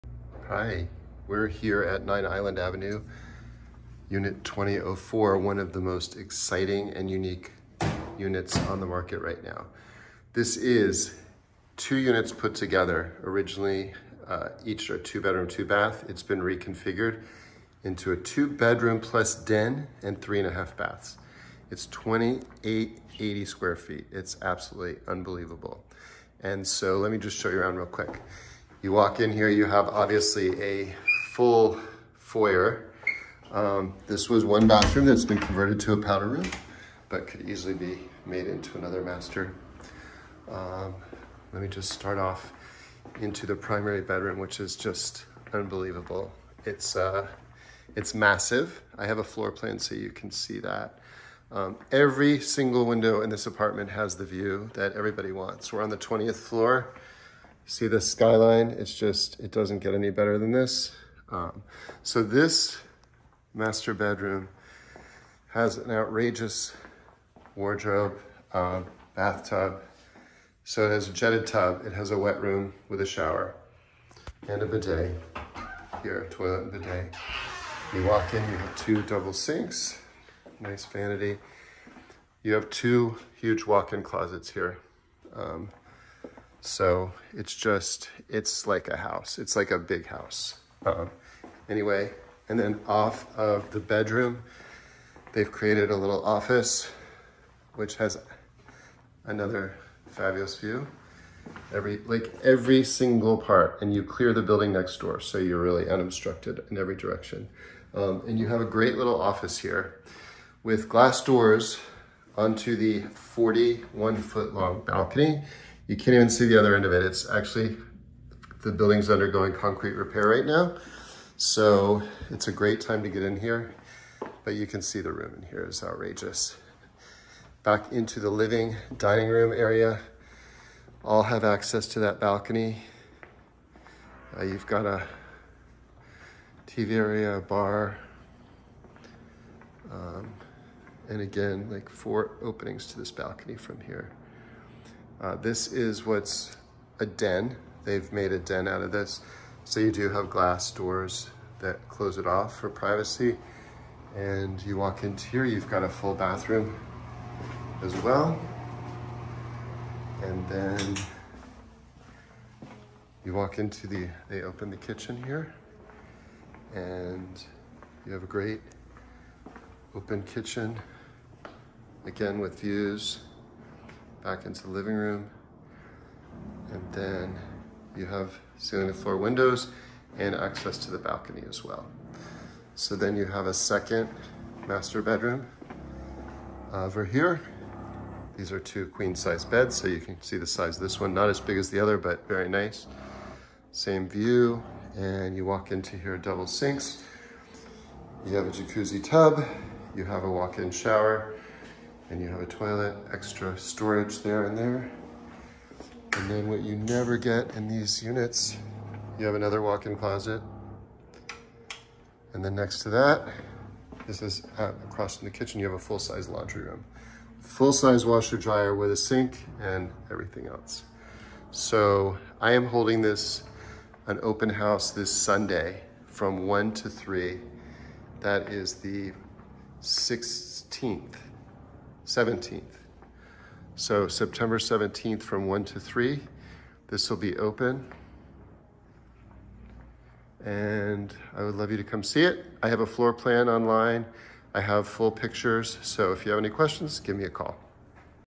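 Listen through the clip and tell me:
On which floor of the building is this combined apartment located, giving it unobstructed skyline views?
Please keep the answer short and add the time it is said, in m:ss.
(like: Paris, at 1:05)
20th floor, at 0:55.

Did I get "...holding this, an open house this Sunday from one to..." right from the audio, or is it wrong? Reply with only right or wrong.
right.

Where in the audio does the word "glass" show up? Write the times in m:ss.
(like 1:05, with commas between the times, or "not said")
1:50, 2:30.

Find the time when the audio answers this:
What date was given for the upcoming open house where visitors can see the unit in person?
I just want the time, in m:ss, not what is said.
3:54.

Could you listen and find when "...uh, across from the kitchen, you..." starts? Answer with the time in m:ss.
3:34.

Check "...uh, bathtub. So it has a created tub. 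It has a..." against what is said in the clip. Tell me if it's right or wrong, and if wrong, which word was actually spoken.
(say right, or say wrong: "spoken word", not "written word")
wrong: "jetted", not "created".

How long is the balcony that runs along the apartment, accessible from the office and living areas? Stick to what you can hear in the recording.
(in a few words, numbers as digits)
41 feet.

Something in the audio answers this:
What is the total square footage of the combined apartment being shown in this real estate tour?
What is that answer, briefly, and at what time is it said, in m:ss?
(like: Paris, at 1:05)
2880, at 0:21.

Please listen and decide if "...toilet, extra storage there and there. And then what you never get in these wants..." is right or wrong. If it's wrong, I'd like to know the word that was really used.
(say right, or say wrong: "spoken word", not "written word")
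wrong: "units", not "wants".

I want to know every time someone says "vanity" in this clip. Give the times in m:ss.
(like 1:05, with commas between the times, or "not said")
1:20.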